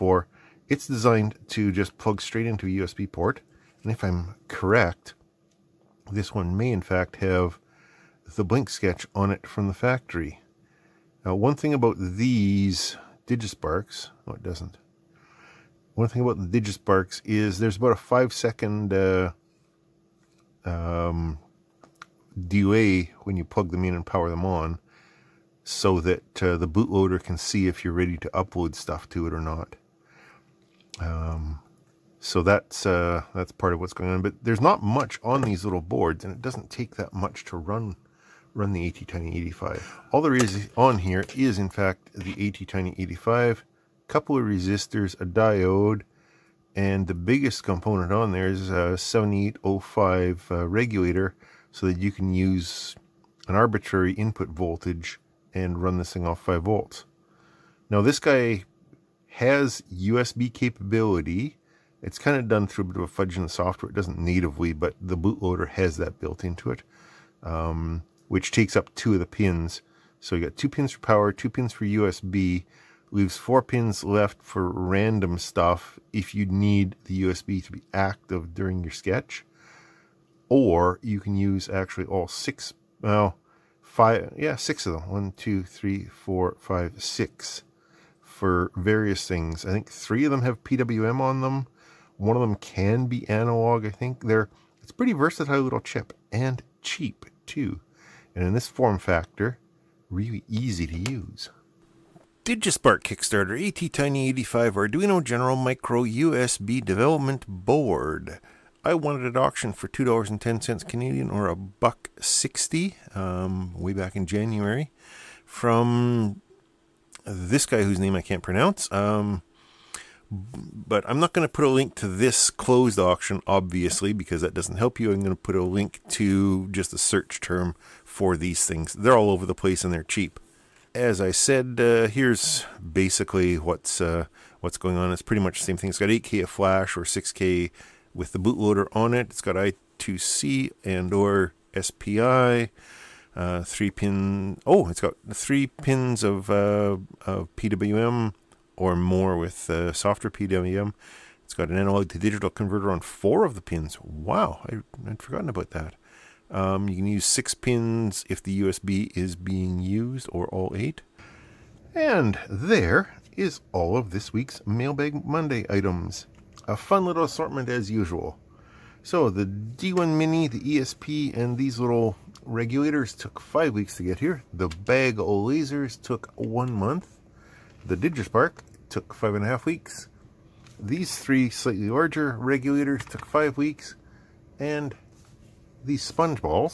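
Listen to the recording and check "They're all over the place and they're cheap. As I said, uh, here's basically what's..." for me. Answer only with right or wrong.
right.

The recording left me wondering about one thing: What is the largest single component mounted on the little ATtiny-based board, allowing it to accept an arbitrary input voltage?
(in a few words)
7805 regulator.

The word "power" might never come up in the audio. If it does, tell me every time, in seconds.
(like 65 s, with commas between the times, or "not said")
24 s, 70 s.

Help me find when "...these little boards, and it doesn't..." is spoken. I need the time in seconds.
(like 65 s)
35 s.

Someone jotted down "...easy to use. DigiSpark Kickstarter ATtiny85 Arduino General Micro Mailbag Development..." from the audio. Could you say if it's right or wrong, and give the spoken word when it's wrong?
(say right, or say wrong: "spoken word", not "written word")
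wrong: "USB", not "Mailbag".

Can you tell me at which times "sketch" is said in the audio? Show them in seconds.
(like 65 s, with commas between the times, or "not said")
8 s, 78 s.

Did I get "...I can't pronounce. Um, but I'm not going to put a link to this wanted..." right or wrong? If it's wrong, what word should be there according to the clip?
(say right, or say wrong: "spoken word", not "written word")
wrong: "closed", not "wanted".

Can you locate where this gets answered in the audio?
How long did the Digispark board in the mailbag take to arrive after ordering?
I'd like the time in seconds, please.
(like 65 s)
179 s.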